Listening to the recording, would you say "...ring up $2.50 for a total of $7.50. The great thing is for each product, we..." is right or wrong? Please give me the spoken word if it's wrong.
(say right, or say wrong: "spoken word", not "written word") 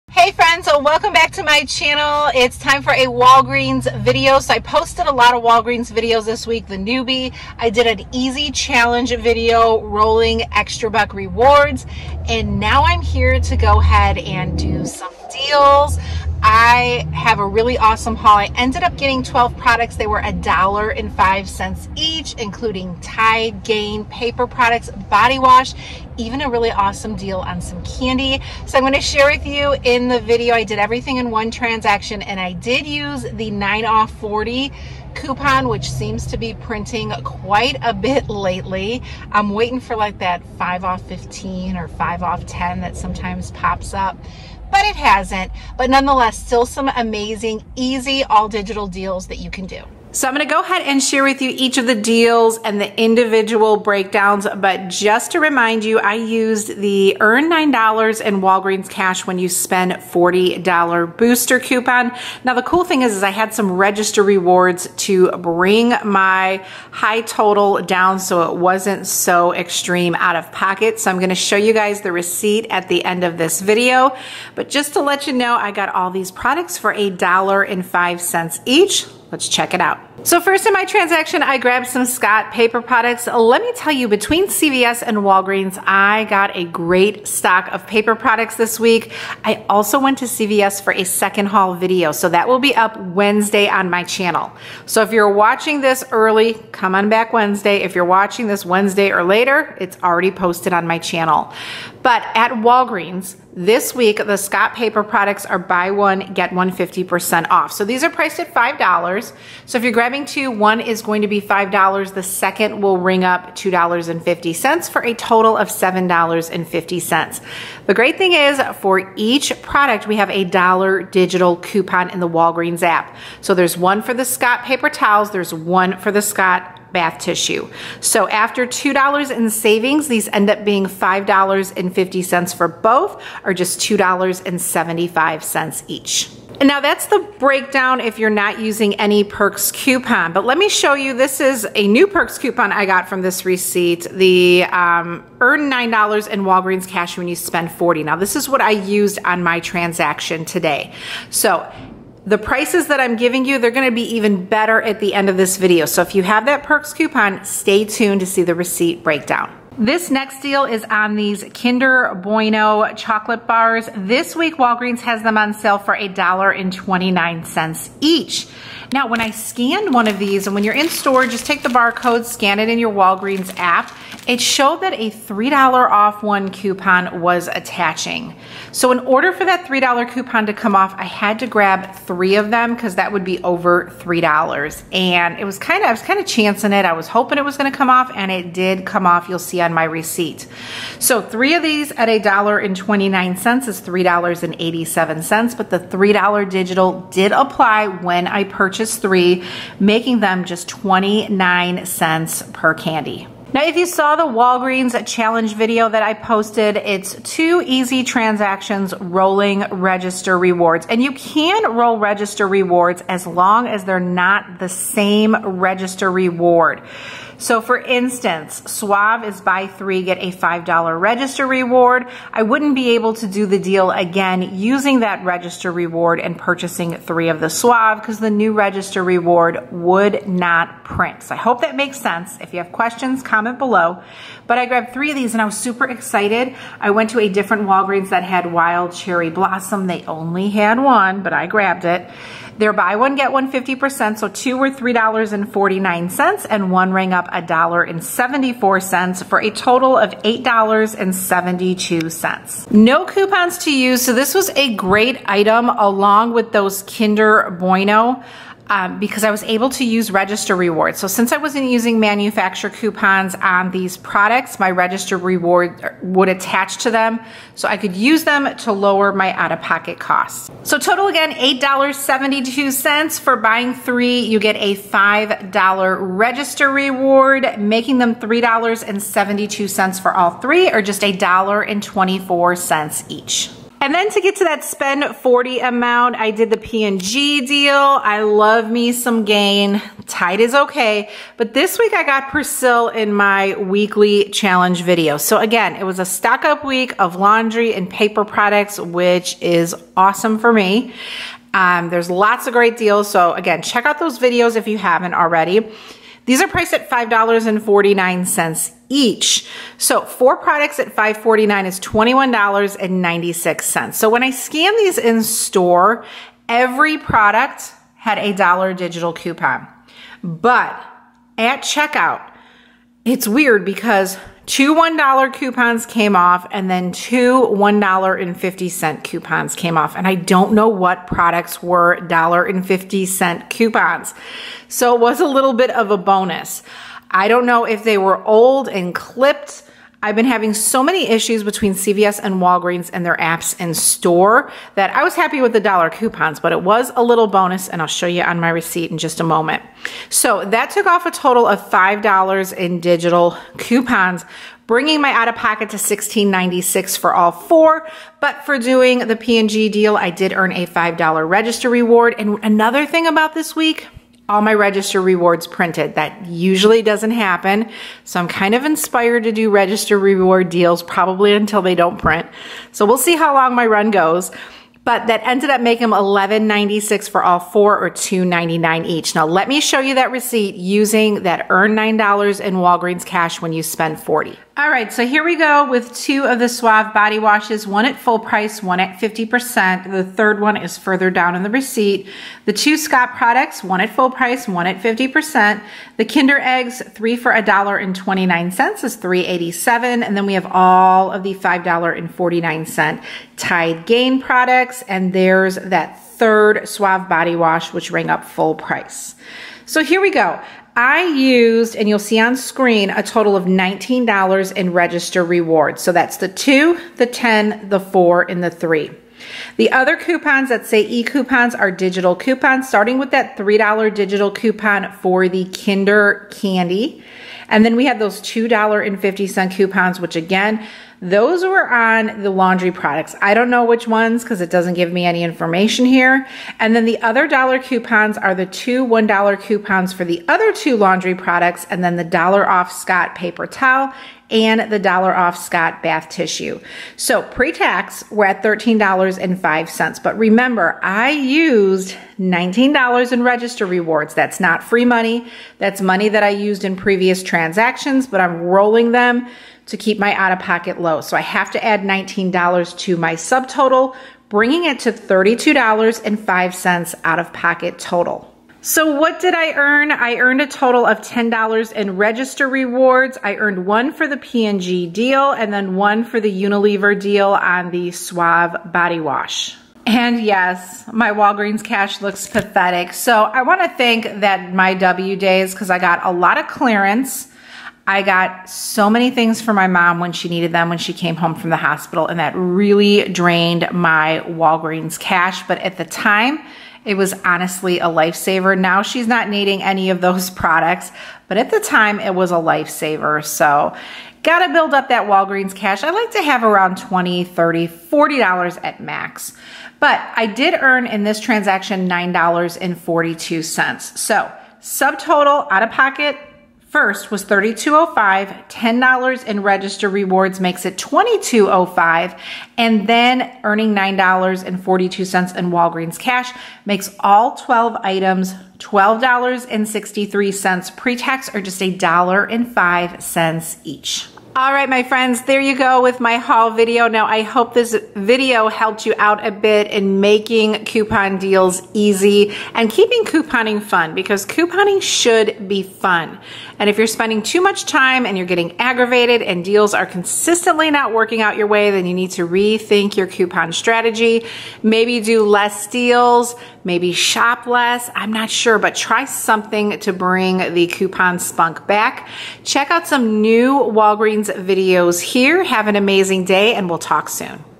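right.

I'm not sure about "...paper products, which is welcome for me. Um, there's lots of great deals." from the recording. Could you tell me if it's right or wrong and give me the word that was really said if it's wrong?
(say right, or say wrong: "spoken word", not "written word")
wrong: "awesome", not "welcome".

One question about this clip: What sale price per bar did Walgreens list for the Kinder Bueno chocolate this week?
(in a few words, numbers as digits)
$1.29.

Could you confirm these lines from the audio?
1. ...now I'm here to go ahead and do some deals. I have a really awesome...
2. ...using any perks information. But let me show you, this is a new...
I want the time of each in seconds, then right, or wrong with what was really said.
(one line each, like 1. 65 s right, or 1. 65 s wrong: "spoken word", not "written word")
1. 12 s right
2. 138 s wrong: "coupon", not "information".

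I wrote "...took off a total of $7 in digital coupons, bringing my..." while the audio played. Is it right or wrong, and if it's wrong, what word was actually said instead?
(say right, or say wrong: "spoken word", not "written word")
wrong: "5", not "7".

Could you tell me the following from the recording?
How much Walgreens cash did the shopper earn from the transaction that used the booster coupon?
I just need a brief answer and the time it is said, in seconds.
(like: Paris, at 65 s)
$9.42, at 511 s.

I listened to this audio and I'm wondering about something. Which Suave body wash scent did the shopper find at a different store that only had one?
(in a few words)
wild cherry blossom.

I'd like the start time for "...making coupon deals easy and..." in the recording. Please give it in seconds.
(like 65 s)
539 s.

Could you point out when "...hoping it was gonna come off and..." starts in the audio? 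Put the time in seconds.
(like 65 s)
187 s.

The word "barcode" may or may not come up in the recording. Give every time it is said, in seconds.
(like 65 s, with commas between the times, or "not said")
171 s.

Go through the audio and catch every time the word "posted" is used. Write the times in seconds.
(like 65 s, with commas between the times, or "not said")
4 s, 100 s, 206 s.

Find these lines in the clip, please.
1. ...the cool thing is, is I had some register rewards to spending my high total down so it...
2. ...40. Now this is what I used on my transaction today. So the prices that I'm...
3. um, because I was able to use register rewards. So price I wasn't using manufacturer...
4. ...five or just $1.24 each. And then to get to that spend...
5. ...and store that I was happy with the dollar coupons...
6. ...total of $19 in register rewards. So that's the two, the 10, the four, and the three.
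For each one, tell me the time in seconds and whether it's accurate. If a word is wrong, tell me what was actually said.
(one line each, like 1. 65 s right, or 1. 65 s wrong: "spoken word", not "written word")
1. 62 s wrong: "bring", not "spending"
2. 147 s right
3. 258 s wrong: "since", not "price"
4. 280 s wrong: "three", not "five"
5. 343 s right
6. 413 s right.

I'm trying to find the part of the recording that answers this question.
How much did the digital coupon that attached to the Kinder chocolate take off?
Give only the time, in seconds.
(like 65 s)
175 s.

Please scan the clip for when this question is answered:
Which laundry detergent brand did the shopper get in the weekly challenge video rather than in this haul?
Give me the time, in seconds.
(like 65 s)
292 s.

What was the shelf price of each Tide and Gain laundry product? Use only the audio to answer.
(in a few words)
$5.49.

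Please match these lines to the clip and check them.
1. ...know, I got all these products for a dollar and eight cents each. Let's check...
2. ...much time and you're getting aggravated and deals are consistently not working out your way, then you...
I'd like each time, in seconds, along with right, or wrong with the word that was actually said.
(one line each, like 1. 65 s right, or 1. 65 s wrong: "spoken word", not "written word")
1. 75 s wrong: "five", not "eight"
2. 547 s right.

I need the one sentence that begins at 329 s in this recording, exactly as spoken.
And I don't know what products were $1.50 coupons.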